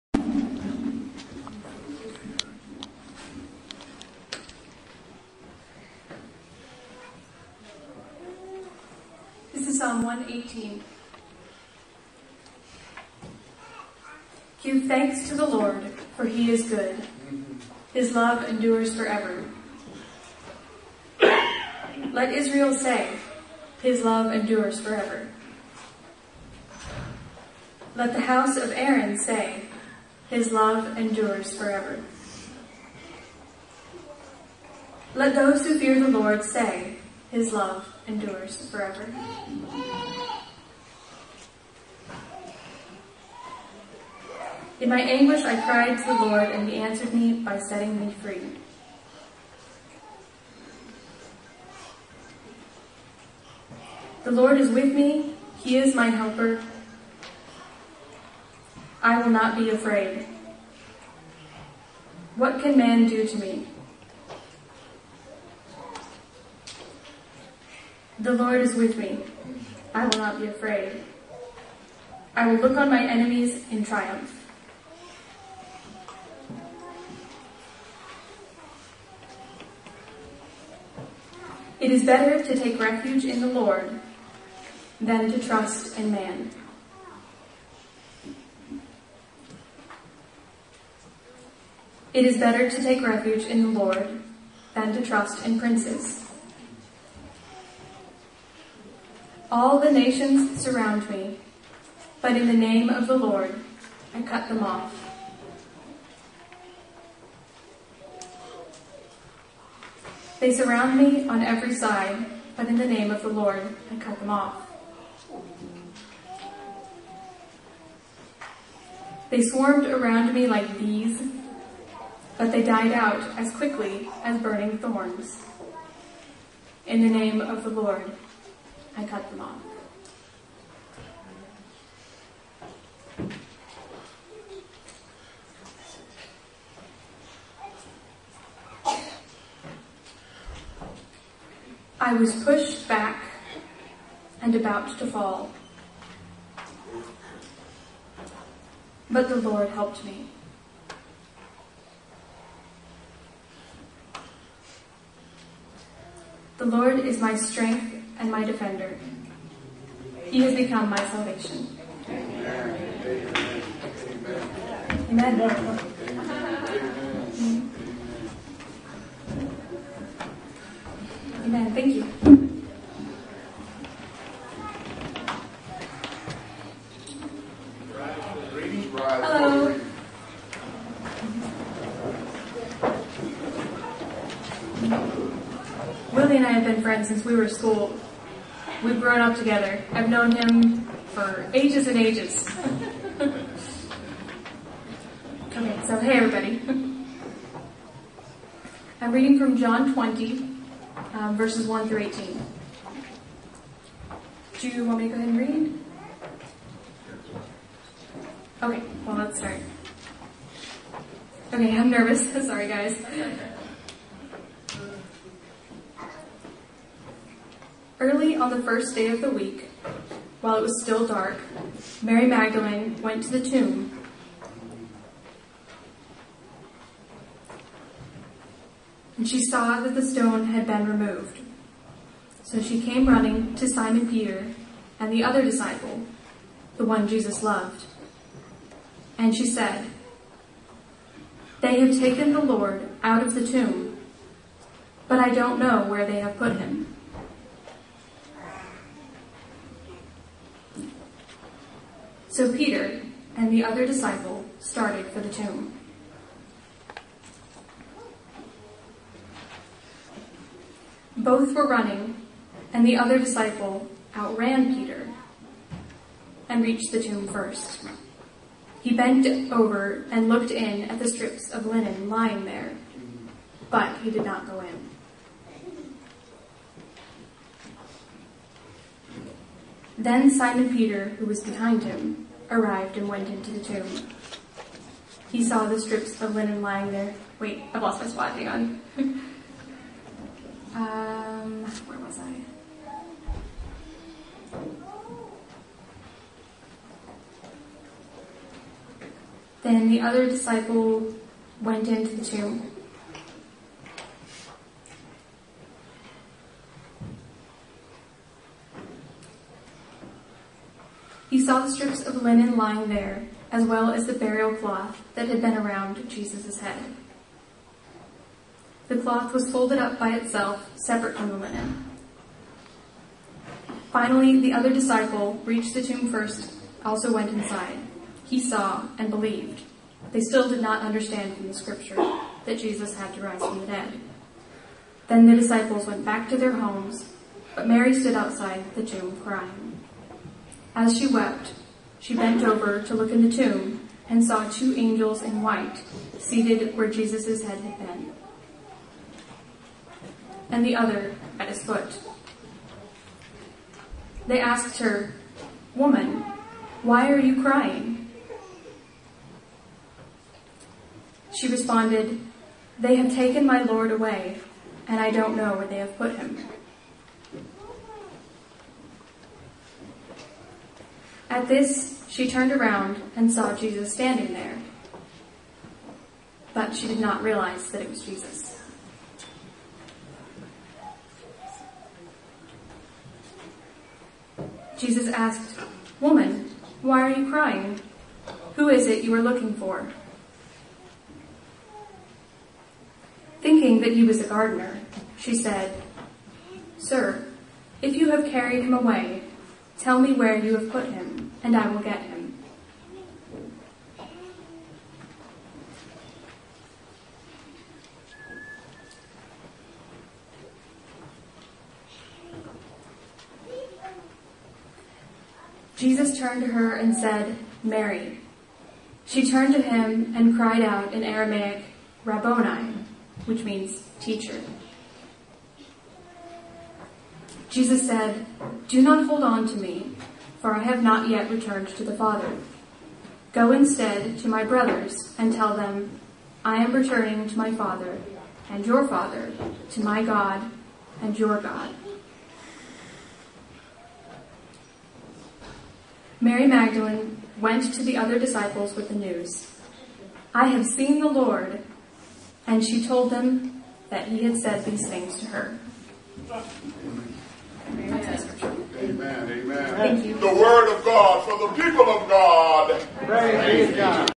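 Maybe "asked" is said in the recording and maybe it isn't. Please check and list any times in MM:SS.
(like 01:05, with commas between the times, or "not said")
05:54, 06:25.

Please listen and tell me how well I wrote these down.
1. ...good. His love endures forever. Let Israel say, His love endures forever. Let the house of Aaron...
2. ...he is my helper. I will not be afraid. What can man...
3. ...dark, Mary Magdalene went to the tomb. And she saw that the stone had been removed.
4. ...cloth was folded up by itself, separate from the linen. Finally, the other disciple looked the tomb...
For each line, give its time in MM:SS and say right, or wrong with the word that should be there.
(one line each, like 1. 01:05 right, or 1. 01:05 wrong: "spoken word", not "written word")
1. 00:16 right
2. 00:55 right
3. 03:41 right
4. 05:18 wrong: "reached", not "looked".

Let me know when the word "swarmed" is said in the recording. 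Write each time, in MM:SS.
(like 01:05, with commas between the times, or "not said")
01:59.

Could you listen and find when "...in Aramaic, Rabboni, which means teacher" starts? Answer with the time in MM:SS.
07:00.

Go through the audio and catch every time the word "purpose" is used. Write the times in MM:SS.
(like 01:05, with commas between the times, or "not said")
not said.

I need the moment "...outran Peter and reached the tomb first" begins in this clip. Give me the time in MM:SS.
04:24.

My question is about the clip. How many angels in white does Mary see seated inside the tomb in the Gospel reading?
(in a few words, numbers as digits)
2.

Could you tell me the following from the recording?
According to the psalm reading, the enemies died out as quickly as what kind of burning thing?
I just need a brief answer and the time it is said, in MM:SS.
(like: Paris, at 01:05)
burning thorns, at 02:04.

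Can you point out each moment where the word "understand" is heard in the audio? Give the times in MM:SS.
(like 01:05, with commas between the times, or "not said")
05:30.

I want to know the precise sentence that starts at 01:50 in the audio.
They surround me on every side, but in the name of the Lord I cut them off.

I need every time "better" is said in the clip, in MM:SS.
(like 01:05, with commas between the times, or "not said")
01:22, 01:32.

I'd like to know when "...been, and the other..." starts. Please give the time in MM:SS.
05:47.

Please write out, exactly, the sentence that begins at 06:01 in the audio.
She responded, They have taken my Lord away, and I don't know where they have put him.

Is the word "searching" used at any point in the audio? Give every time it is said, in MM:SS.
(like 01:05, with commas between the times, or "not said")
not said.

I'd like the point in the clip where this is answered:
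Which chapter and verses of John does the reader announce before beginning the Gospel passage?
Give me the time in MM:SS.
03:19.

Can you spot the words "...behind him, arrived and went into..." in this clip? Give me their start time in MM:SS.
04:41.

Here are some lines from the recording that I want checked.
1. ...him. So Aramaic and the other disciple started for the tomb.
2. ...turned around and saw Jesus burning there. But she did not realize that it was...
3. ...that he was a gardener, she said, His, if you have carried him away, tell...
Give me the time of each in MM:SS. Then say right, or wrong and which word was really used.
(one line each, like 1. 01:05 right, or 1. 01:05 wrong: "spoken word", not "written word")
1. 04:06 wrong: "Peter", not "Aramaic"
2. 06:12 wrong: "standing", not "burning"
3. 06:33 wrong: "Sir", not "His".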